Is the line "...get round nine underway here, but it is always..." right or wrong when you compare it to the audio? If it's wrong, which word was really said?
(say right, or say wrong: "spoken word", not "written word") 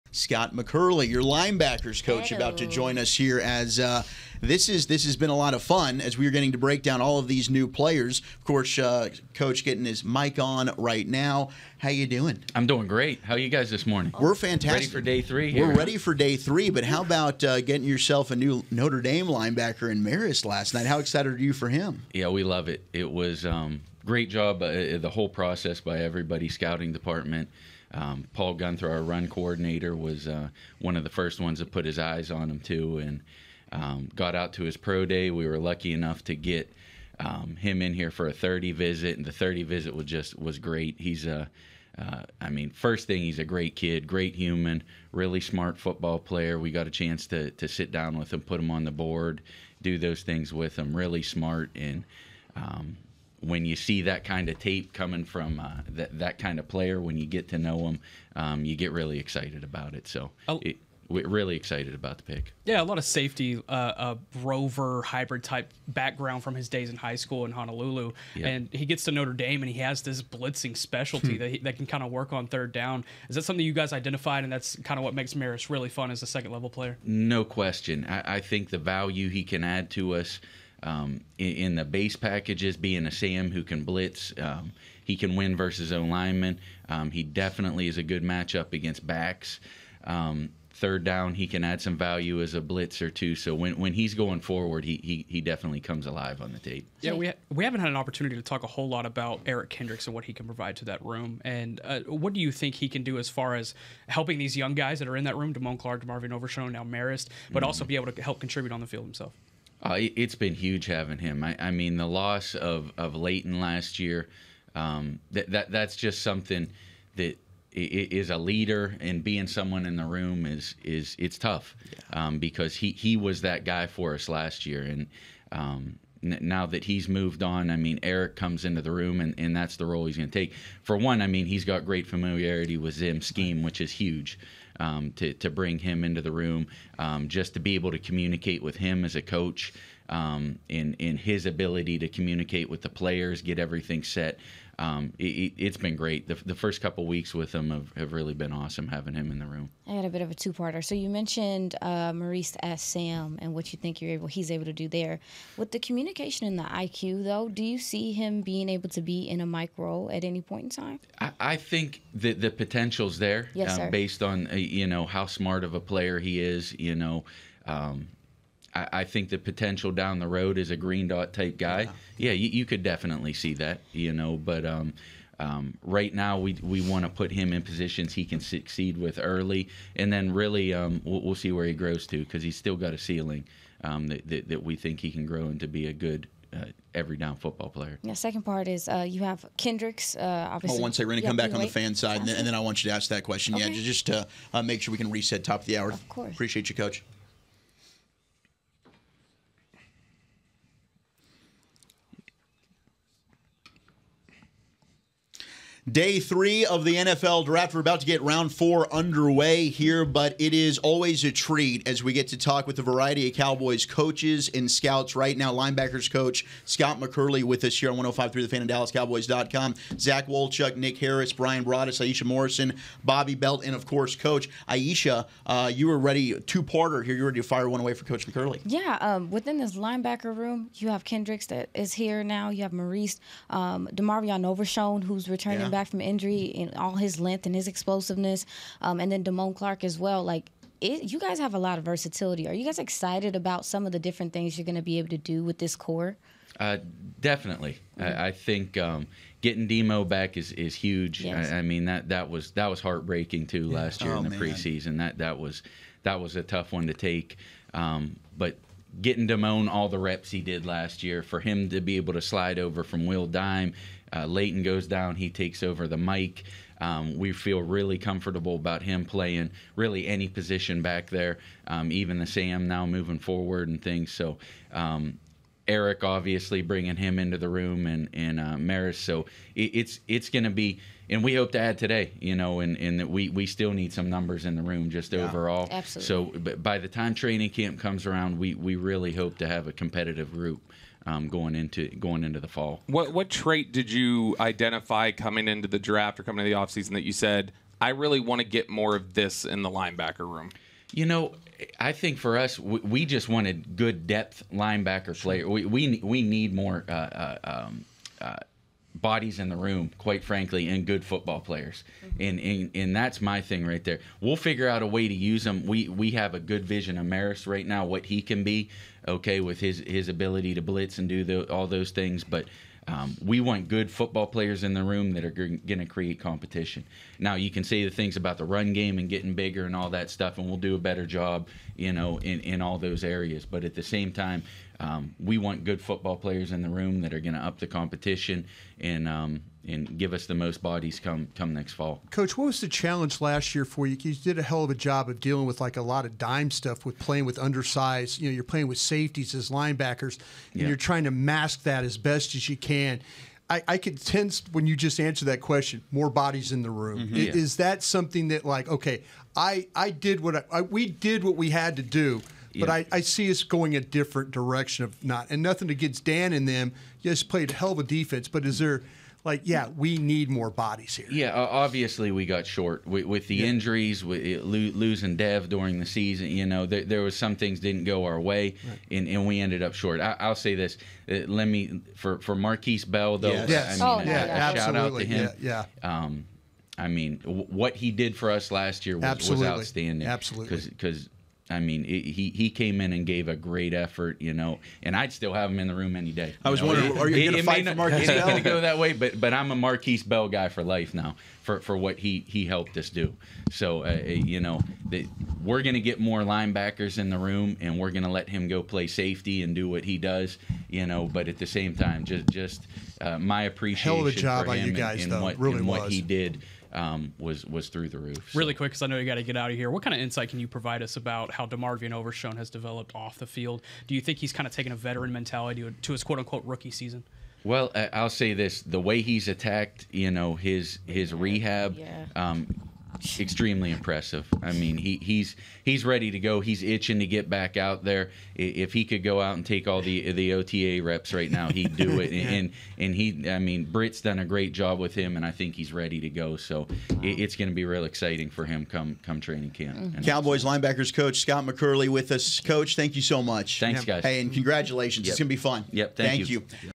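wrong: "four", not "nine".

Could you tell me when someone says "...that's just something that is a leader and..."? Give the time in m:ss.
1:55.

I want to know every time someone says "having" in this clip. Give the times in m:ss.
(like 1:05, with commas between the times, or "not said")
1:50, 2:28.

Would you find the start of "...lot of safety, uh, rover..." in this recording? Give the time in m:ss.
1:02.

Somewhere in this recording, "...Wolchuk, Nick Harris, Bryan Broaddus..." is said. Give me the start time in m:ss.
3:40.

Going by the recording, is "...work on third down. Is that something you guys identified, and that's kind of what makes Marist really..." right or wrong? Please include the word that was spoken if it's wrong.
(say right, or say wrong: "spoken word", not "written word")
right.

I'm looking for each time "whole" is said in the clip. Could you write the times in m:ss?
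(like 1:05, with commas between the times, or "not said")
0:25, 1:38.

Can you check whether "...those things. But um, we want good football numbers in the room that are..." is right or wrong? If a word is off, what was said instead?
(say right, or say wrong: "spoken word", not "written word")
wrong: "players", not "numbers".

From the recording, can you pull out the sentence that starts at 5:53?
I, I could sense when you just answer that question, more bodies in the room.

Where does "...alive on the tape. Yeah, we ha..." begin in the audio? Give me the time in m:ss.
1:36.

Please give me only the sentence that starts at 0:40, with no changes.
He's a uh, I mean, first thing, he's a great kid, great human, really smart football player.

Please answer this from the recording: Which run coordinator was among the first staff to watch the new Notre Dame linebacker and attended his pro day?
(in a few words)
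Paul Guenther.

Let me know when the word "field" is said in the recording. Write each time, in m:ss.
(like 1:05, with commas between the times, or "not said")
1:48, 7:03.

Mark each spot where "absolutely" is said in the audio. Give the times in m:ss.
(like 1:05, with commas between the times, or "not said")
4:45, 6:24, 6:30.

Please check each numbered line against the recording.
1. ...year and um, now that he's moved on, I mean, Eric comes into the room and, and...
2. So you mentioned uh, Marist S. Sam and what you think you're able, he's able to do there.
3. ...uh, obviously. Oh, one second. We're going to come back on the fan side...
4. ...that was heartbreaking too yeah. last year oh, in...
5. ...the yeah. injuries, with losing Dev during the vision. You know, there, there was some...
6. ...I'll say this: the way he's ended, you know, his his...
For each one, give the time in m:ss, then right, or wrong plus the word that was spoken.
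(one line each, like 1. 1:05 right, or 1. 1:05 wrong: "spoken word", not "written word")
1. 2:04 right
2. 2:30 wrong: "Maurice", not "Marist"
3. 3:10 right
4. 4:12 right
5. 6:13 wrong: "season", not "vision"
6. 7:07 wrong: "attacked", not "ended".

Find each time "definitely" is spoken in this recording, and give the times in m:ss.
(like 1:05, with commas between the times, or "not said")
1:27, 1:35, 2:52, 4:07.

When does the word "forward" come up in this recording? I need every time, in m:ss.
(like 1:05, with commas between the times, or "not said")
1:34, 4:33.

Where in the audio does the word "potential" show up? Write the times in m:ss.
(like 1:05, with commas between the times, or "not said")
2:42, 2:49.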